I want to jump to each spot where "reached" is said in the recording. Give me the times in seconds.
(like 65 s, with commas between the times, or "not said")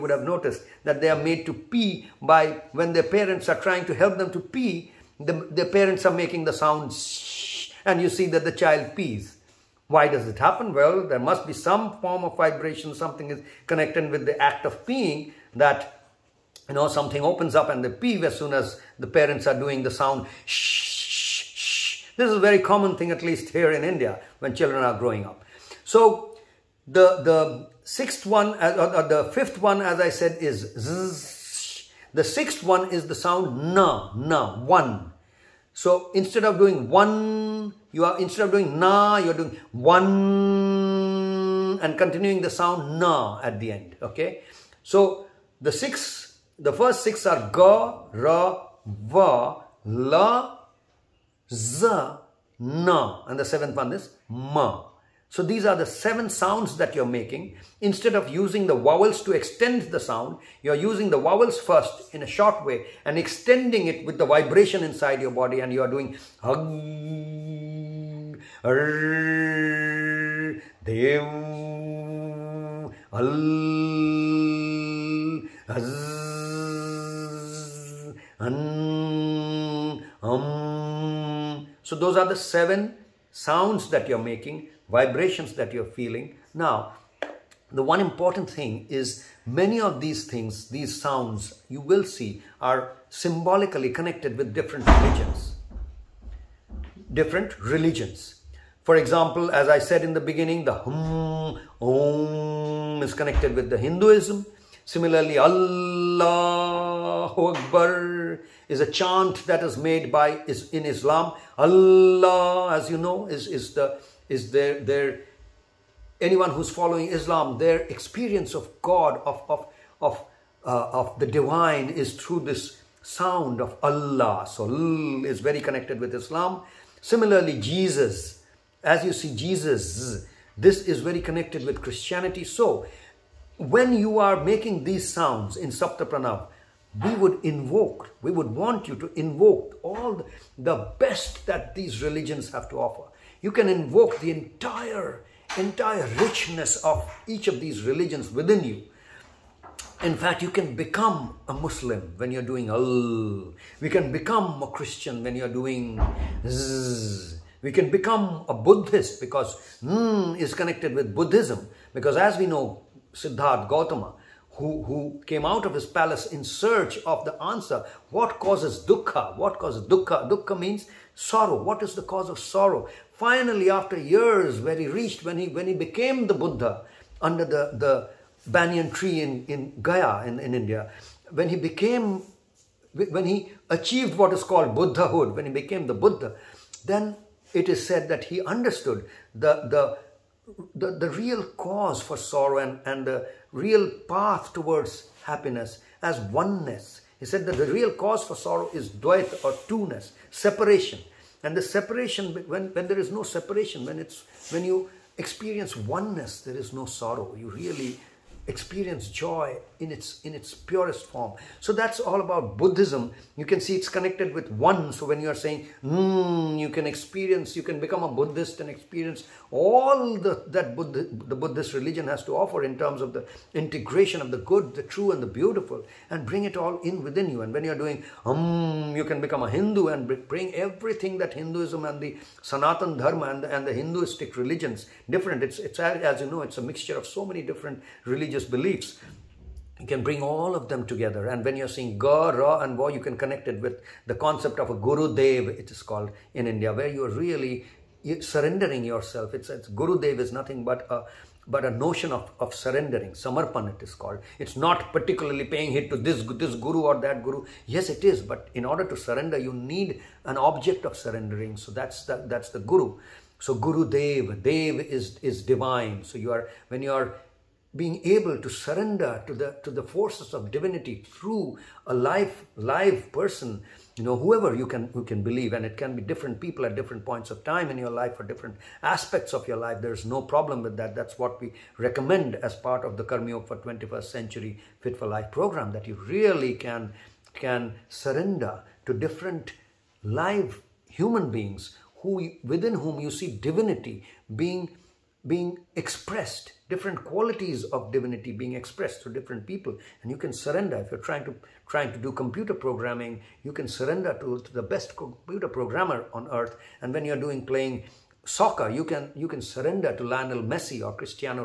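174 s.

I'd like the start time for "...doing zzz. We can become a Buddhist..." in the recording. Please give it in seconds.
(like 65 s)
155 s.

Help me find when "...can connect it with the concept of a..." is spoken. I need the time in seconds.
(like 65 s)
242 s.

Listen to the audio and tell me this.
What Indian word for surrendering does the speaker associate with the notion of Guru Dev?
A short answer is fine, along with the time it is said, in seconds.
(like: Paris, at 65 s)
samarpan, at 253 s.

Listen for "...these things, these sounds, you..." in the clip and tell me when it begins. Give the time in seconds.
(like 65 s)
89 s.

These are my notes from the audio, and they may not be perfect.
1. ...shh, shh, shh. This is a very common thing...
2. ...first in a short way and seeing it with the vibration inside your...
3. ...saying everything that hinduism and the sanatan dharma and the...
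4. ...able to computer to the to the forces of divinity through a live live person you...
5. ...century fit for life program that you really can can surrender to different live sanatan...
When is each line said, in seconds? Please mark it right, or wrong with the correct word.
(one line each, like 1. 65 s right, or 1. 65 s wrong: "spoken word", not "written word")
1. 20 s right
2. 61 s wrong: "extending", not "seeing"
3. 230 s wrong: "bring", not "saying"
4. 268 s wrong: "surrender", not "computer"
5. 284 s wrong: "human", not "sanatan".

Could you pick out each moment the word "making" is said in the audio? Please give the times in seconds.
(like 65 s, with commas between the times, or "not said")
6 s, 57 s, 84 s, 134 s.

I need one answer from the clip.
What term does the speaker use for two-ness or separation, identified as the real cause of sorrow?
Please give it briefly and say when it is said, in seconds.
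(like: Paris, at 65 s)
dvaita, at 198 s.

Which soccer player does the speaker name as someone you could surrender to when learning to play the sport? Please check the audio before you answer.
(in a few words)
Lionel Messi.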